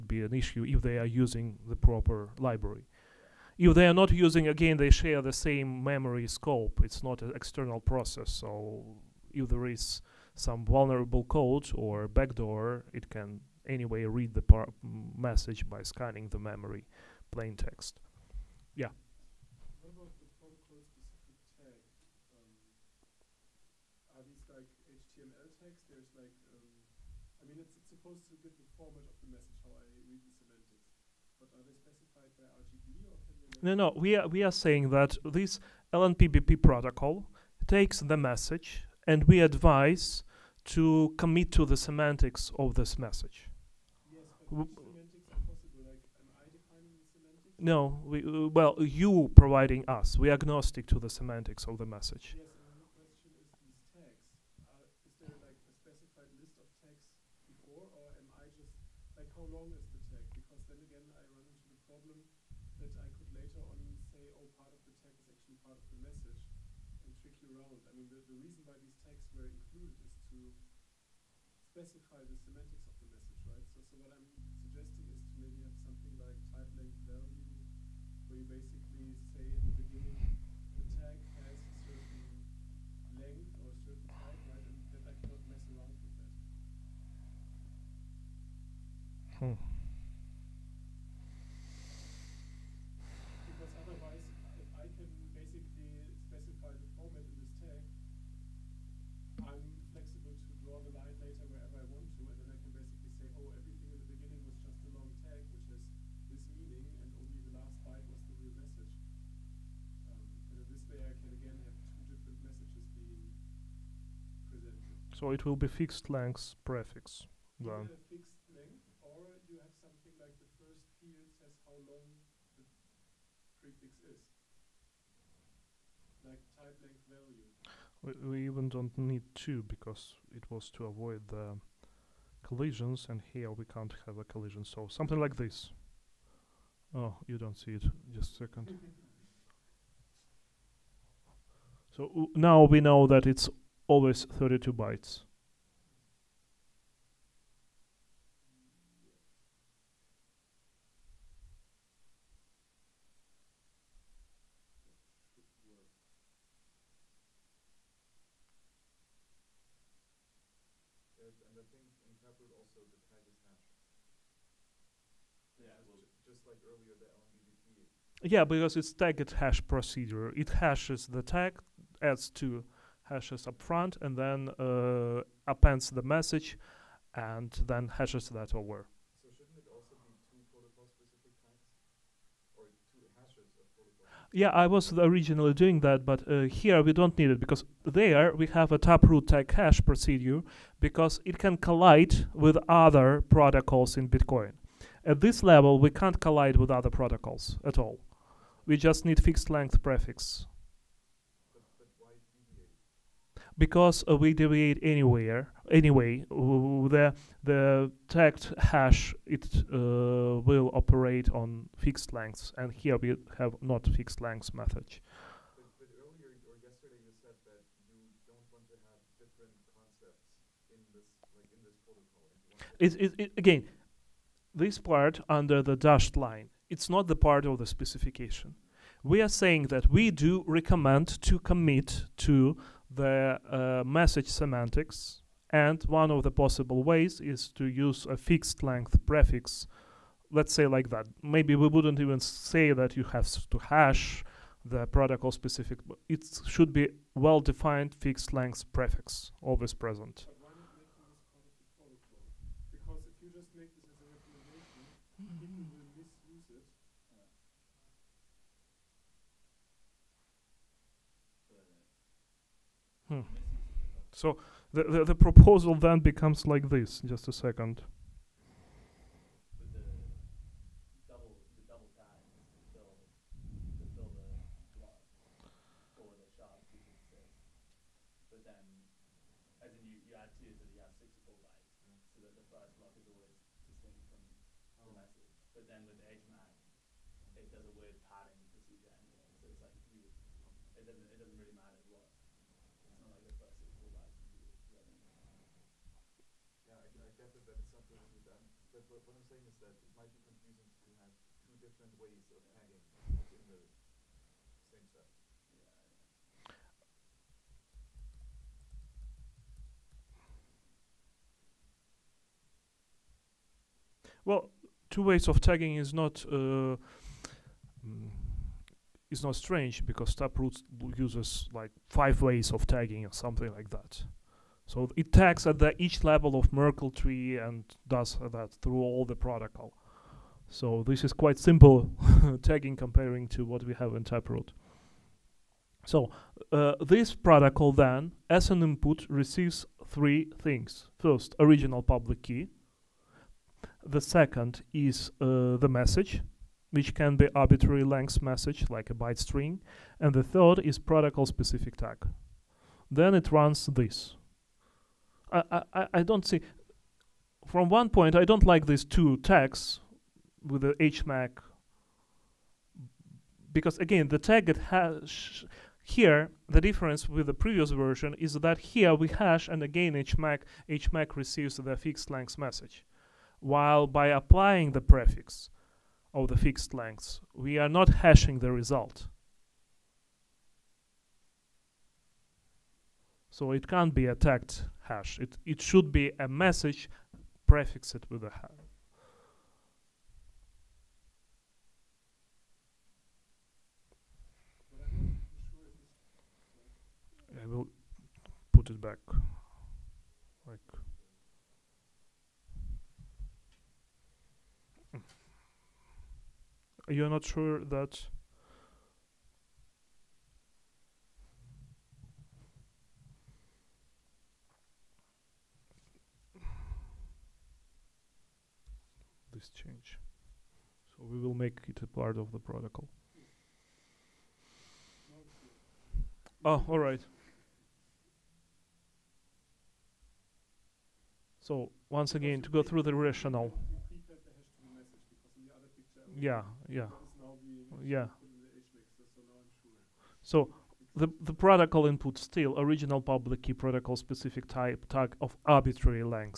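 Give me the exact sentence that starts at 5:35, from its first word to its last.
So uh, this protocol then, as an input, receives three things.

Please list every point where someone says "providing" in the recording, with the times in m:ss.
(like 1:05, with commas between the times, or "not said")
0:49.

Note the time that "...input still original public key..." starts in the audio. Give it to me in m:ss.
7:21.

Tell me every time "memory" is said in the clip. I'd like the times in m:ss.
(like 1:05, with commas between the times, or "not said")
0:05, 0:16.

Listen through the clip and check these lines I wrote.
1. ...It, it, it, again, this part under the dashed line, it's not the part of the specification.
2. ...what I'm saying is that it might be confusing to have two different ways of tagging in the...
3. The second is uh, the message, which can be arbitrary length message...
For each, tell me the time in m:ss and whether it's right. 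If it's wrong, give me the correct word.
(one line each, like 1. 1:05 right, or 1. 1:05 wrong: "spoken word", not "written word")
1. 3:42 right
2. 4:59 right
3. 5:43 right.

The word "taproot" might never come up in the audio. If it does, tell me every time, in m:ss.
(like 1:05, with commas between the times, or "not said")
3:08, 5:20, 5:34.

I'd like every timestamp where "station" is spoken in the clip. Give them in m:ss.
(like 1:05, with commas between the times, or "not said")
not said.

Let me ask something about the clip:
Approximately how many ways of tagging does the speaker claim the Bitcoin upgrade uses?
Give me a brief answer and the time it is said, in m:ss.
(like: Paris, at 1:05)
5, at 5:21.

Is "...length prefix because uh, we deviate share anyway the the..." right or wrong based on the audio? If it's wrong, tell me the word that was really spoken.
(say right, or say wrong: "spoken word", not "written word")
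wrong: "anywhere", not "share".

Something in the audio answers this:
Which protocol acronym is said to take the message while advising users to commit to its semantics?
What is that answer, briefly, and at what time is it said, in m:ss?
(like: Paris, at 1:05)
LNPBP, at 0:35.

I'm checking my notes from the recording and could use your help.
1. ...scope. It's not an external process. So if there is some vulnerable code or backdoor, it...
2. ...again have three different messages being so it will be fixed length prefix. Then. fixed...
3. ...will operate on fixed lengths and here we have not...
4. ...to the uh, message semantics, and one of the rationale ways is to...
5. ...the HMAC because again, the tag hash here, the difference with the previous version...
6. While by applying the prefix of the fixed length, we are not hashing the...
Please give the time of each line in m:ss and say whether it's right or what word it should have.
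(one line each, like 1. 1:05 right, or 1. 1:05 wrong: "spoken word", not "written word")
1. 0:06 right
2. 1:51 wrong: "two", not "three"
3. 3:30 right
4. 3:52 wrong: "possible", not "rationale"
5. 6:00 right
6. 6:13 right.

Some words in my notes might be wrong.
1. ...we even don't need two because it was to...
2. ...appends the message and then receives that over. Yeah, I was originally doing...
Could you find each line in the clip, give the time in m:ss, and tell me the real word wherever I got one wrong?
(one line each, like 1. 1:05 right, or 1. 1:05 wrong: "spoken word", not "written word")
1. 2:08 right
2. 2:55 wrong: "hashes", not "receives".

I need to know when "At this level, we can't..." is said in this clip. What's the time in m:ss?
3:15.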